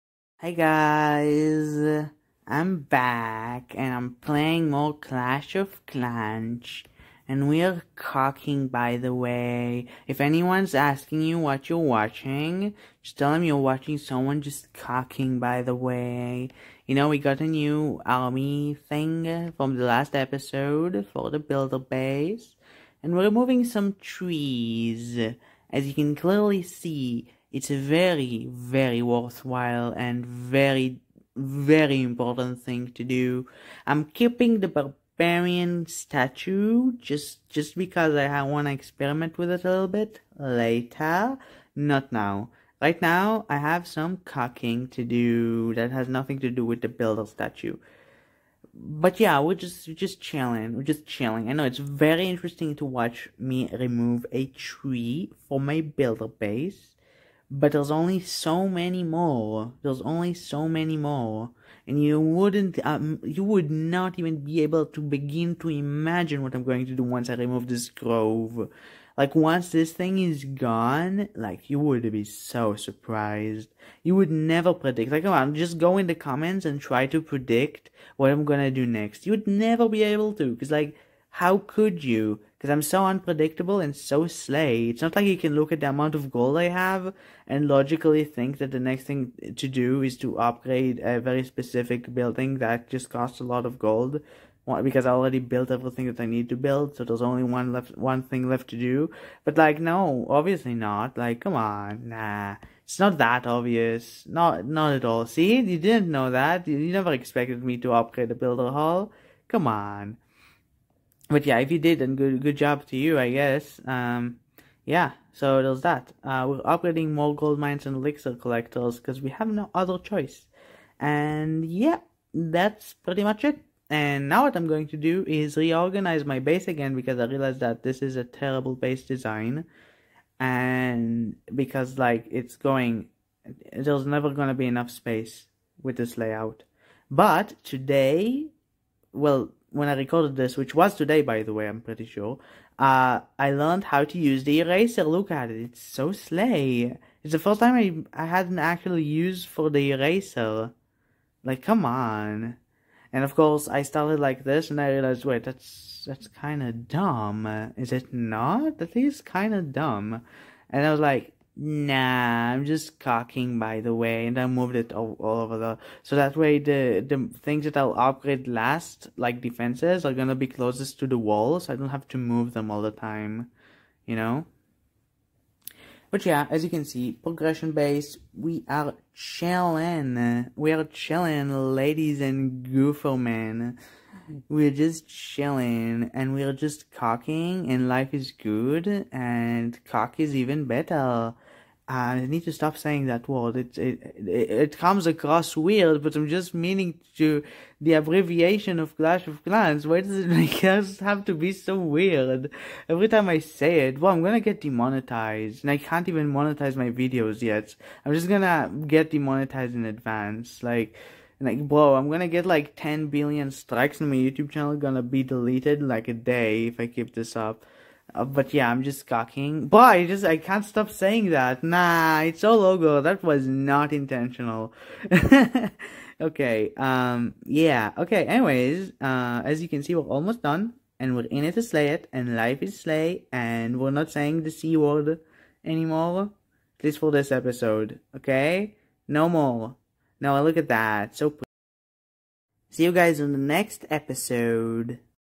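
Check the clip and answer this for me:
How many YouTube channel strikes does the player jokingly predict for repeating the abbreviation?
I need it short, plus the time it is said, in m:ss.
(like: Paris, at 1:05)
10 billion, at 3:32.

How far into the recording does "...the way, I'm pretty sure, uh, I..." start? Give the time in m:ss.
2:21.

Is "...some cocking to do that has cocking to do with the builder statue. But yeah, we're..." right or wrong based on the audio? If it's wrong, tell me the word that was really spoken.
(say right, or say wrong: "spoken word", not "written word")
wrong: "nothing", not "cocking".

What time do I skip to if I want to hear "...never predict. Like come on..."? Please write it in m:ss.
1:14.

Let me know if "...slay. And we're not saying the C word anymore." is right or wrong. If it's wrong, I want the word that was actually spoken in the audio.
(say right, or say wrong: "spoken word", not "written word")
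right.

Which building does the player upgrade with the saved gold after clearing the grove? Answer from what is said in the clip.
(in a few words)
builder hall.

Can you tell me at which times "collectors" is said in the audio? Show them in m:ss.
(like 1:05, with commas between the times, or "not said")
1:58.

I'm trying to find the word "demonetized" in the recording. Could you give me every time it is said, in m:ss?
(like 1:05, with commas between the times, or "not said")
3:24, 3:29.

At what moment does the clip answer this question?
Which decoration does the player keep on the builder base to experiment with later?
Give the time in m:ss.
0:34.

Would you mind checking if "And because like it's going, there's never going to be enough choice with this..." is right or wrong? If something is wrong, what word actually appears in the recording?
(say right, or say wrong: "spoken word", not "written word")
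wrong: "space", not "choice".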